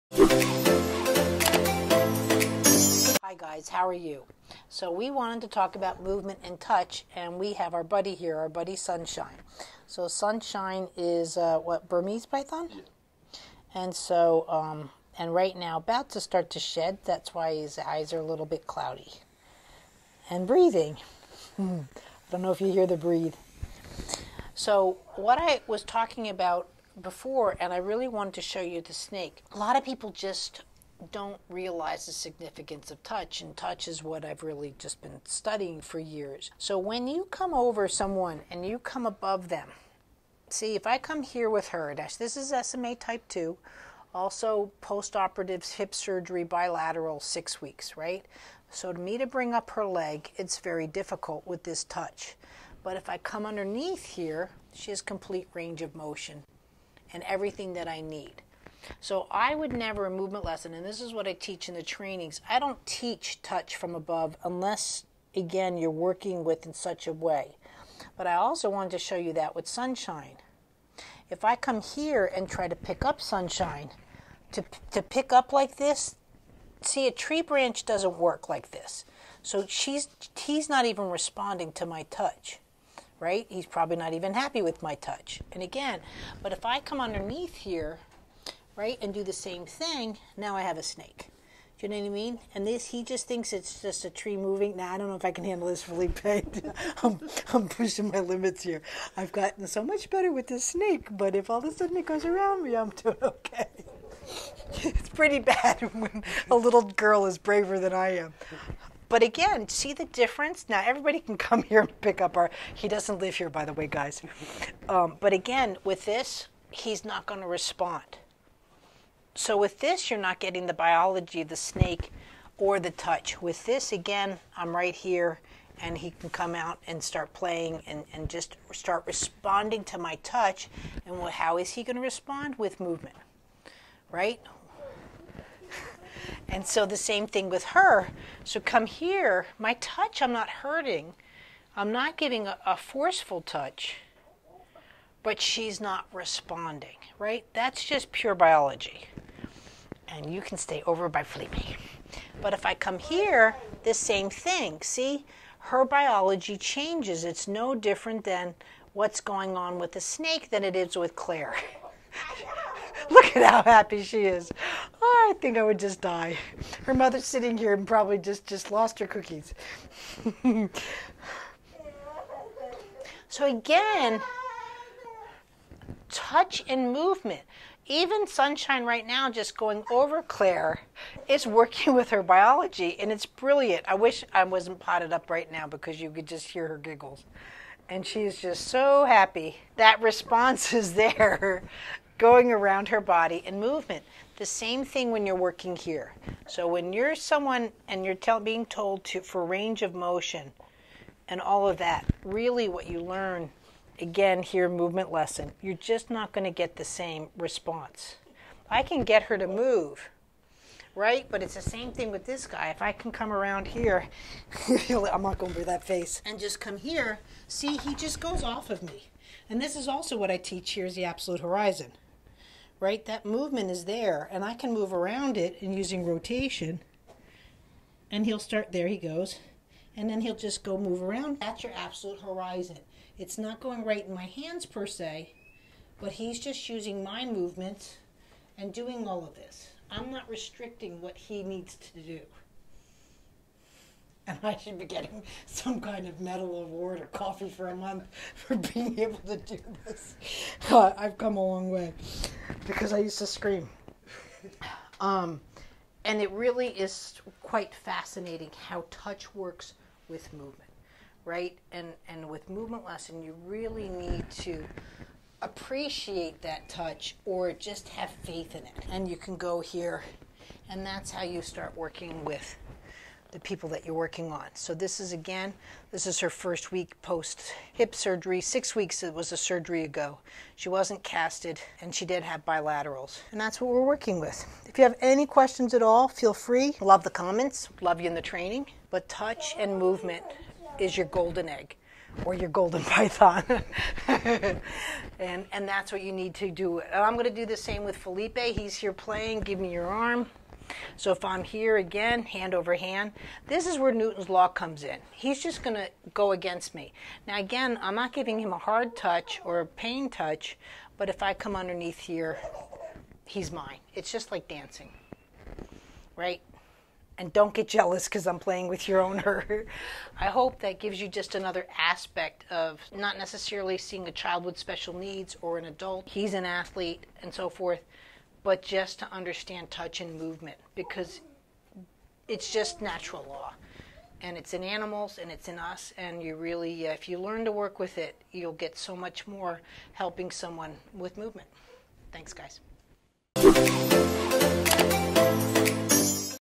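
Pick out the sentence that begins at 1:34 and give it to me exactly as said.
Now, I don't know if I can handle this, Felipe.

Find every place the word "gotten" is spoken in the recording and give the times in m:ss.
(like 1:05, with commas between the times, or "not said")
1:39.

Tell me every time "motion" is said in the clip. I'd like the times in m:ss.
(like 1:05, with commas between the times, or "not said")
0:55, 3:19.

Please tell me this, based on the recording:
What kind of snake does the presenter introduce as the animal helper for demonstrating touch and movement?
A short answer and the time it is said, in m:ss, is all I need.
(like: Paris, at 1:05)
Burmese python, at 0:11.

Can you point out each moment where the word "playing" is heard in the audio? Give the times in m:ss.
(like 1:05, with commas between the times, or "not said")
2:07, 4:58, 5:18.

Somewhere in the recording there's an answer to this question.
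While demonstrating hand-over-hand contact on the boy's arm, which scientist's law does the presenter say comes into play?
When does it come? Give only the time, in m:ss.
5:03.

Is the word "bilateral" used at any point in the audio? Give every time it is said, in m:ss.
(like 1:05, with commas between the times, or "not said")
0:46, 4:42.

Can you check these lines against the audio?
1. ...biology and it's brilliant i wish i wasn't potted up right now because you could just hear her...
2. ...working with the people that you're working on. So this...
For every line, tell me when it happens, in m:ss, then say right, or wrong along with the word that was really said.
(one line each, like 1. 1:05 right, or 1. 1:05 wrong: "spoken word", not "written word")
1. 3:02 right
2. 4:31 right.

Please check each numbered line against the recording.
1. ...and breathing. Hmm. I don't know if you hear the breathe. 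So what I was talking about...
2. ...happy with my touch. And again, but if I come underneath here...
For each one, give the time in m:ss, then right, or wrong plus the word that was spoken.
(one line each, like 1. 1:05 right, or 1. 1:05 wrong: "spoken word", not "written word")
1. 0:20 right
2. 1:24 right.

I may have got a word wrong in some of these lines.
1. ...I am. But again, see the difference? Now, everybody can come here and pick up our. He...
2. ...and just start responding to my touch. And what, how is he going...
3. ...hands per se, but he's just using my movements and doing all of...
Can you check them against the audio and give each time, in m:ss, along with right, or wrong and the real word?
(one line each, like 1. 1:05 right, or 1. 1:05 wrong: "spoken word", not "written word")
1. 1:47 right
2. 2:08 right
3. 3:54 right.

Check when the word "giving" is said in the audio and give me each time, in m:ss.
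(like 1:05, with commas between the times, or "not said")
2:22, 5:08.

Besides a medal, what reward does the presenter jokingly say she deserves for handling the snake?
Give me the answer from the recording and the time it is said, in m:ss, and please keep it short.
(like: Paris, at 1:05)
Coffee for a month, at 4:07.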